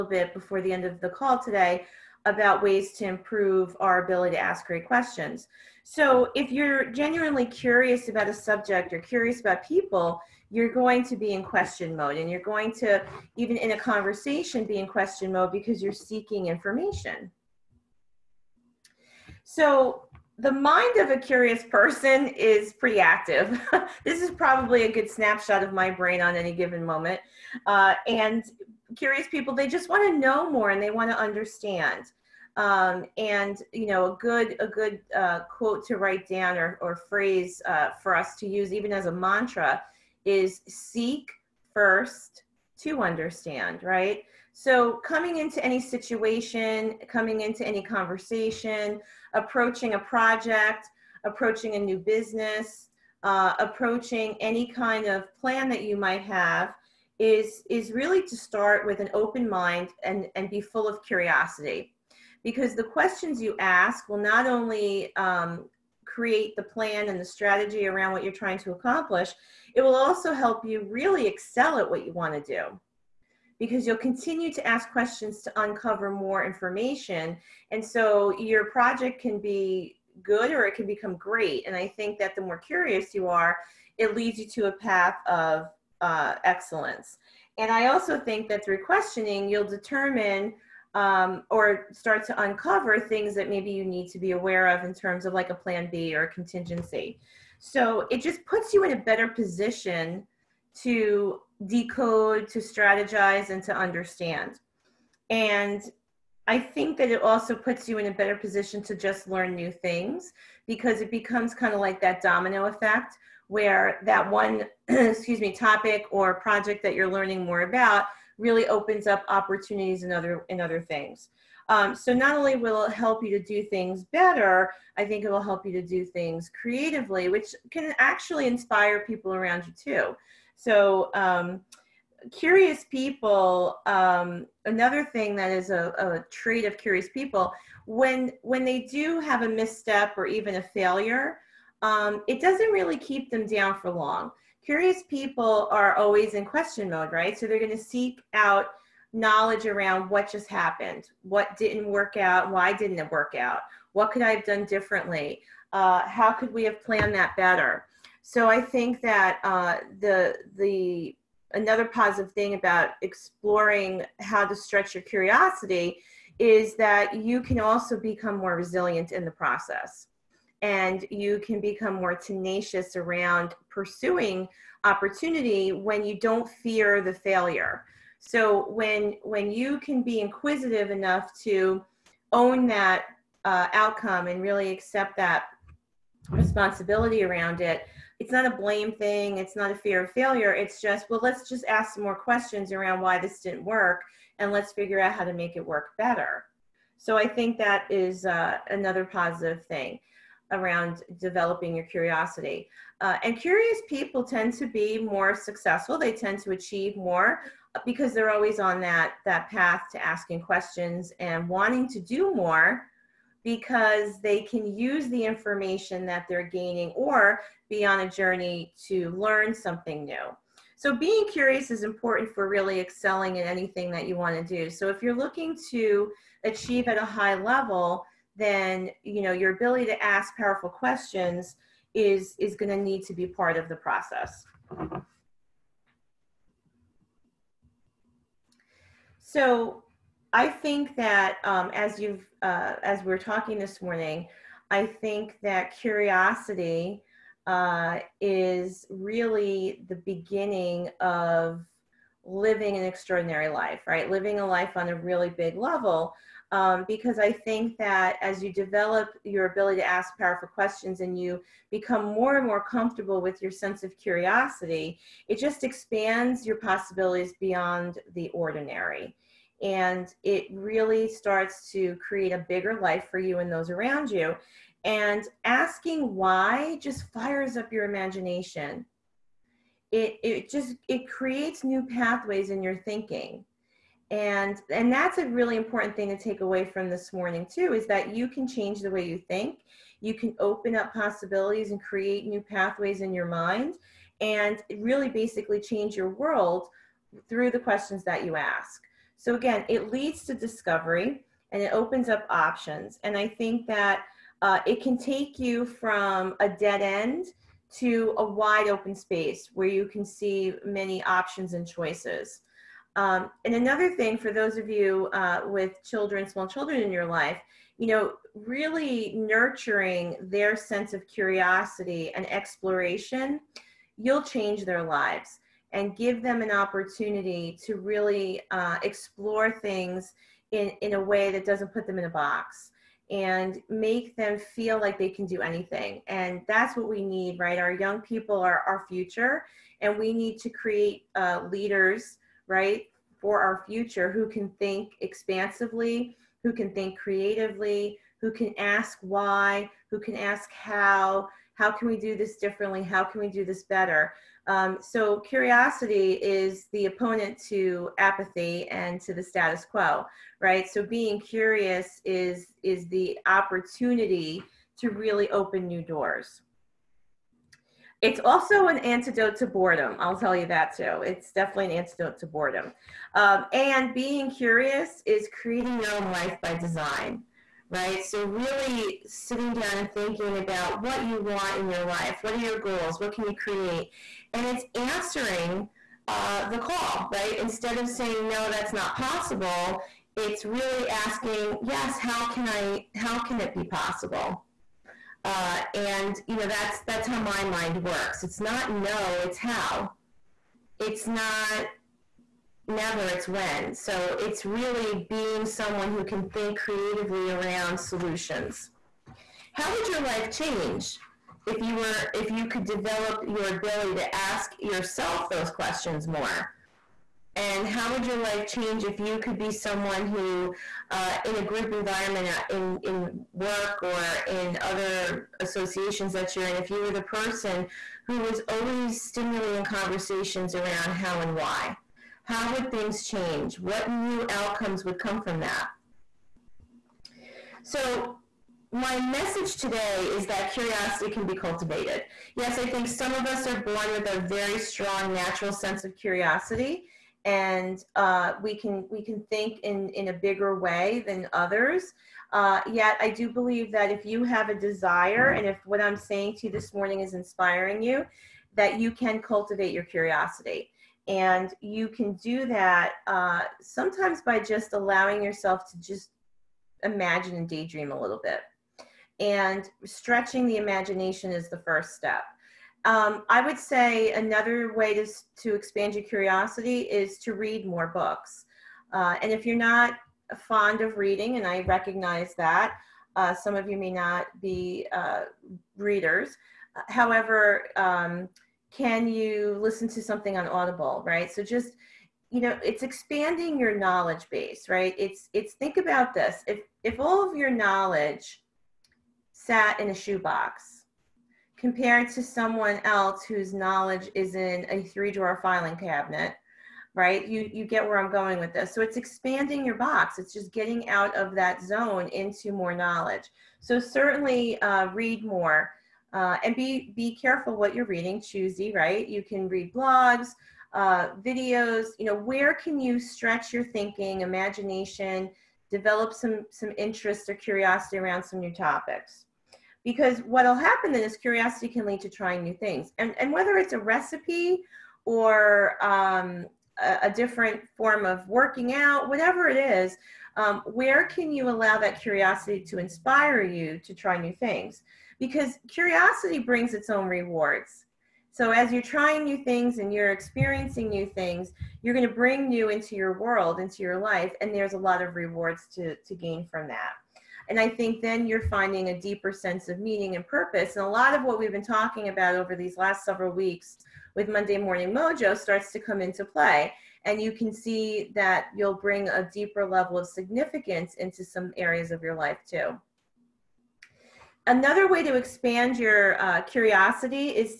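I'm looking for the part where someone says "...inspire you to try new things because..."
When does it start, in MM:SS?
09:02.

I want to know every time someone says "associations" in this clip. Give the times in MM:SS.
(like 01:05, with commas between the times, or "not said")
07:05.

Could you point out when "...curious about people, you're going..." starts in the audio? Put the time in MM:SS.
00:08.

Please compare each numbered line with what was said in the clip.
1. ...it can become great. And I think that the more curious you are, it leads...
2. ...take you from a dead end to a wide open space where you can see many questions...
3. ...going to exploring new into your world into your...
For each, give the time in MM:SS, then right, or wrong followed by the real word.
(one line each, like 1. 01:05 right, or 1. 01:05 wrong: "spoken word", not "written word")
1. 01:20 right
2. 05:04 wrong: "options", not "questions"
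3. 09:11 wrong: "bring", not "exploring".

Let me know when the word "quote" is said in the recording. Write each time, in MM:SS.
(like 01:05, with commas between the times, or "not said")
00:35.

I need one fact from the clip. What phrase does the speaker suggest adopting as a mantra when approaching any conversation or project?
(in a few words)
Seek first to understand.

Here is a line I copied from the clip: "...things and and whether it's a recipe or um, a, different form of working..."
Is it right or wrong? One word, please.
right.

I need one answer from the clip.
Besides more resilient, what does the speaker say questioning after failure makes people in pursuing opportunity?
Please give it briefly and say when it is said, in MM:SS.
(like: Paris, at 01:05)
Tenacious, at 02:52.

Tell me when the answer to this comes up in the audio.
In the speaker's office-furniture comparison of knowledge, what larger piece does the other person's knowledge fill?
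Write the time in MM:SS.
08:24.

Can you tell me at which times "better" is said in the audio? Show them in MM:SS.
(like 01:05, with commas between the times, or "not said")
01:38, 01:48, 02:04, 02:37, 03:15, 05:53.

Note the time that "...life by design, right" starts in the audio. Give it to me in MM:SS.
06:16.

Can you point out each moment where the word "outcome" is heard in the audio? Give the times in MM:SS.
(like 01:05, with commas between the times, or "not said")
03:03, 07:14.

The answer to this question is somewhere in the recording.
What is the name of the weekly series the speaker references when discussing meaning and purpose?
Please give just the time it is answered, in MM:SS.
09:24.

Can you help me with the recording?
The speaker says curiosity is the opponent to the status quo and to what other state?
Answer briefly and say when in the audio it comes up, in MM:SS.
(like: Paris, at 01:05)
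Apathy, at 05:57.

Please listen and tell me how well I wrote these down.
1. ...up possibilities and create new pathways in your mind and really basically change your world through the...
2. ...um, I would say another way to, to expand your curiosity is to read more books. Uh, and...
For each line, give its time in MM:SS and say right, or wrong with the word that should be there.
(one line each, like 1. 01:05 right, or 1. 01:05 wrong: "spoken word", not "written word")
1. 04:50 right
2. 07:52 right.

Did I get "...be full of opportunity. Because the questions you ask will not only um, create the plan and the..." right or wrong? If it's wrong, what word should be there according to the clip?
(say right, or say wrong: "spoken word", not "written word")
wrong: "curiosity", not "opportunity".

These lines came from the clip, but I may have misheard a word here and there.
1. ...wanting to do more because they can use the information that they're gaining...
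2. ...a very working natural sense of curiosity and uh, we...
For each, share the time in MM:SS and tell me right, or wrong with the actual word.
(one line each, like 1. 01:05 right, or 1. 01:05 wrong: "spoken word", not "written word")
1. 03:31 right
2. 07:24 wrong: "strong", not "working".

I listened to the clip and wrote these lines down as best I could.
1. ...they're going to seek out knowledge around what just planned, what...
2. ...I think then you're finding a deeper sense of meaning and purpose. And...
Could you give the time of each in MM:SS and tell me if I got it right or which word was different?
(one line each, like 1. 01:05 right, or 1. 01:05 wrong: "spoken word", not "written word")
1. 02:27 wrong: "happened", not "planned"
2. 09:17 right.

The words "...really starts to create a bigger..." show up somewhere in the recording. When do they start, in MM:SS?
04:30.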